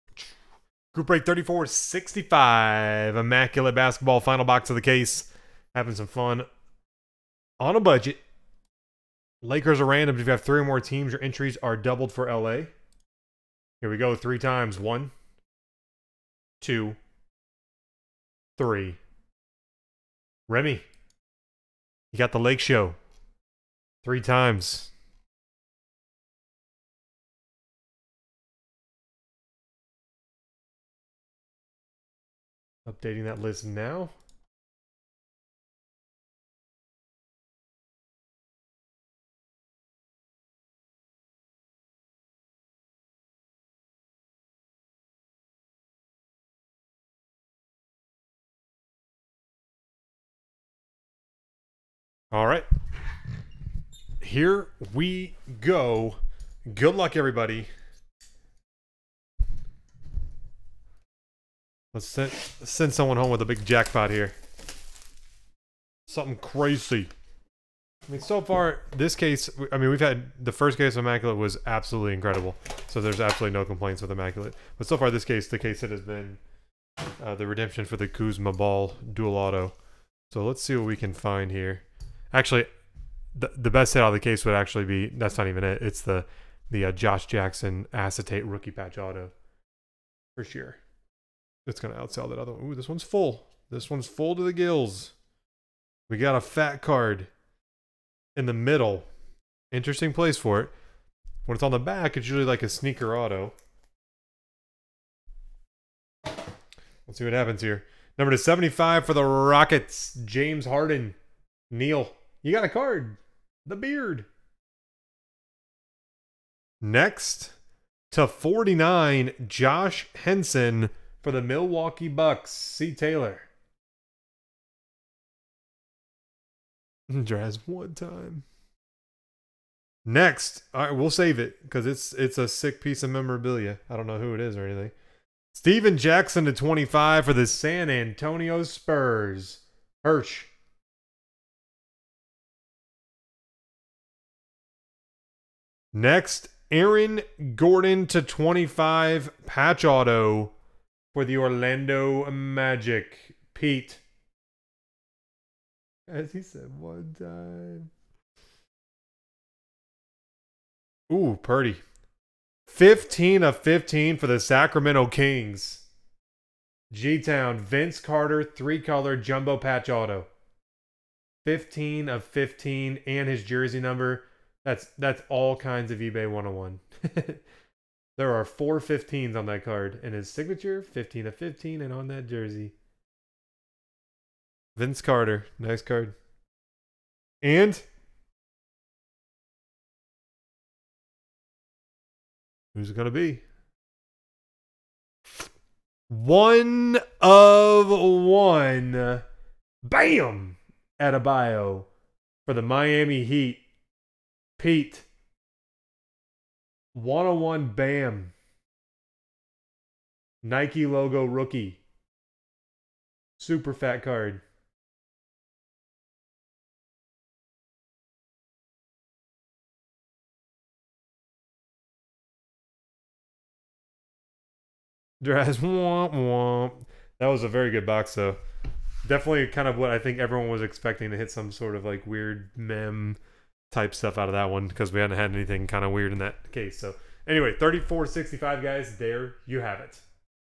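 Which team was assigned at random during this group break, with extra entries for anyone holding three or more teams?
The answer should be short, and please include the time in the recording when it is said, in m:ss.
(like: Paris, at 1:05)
Lakers, at 0:09.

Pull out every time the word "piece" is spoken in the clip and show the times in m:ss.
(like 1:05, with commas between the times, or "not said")
2:12.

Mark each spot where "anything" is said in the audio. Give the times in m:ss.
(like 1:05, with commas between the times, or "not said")
2:14, 3:55.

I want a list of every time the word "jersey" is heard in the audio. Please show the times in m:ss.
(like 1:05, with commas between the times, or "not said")
2:53, 3:02.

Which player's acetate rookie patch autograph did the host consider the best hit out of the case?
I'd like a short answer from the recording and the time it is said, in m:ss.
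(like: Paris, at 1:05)
Josh Jackson, at 1:26.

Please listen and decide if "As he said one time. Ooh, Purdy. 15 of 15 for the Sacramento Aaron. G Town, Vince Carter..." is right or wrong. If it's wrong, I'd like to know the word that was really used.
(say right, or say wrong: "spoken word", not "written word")
wrong: "Kings", not "Aaron".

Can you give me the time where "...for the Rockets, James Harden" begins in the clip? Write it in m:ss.
1:49.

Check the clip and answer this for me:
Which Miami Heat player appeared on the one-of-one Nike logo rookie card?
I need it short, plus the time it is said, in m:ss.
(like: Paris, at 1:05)
Bam Adebayo, at 3:19.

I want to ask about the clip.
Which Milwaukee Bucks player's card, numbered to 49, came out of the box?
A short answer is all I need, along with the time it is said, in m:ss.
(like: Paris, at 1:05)
John Henson, at 1:59.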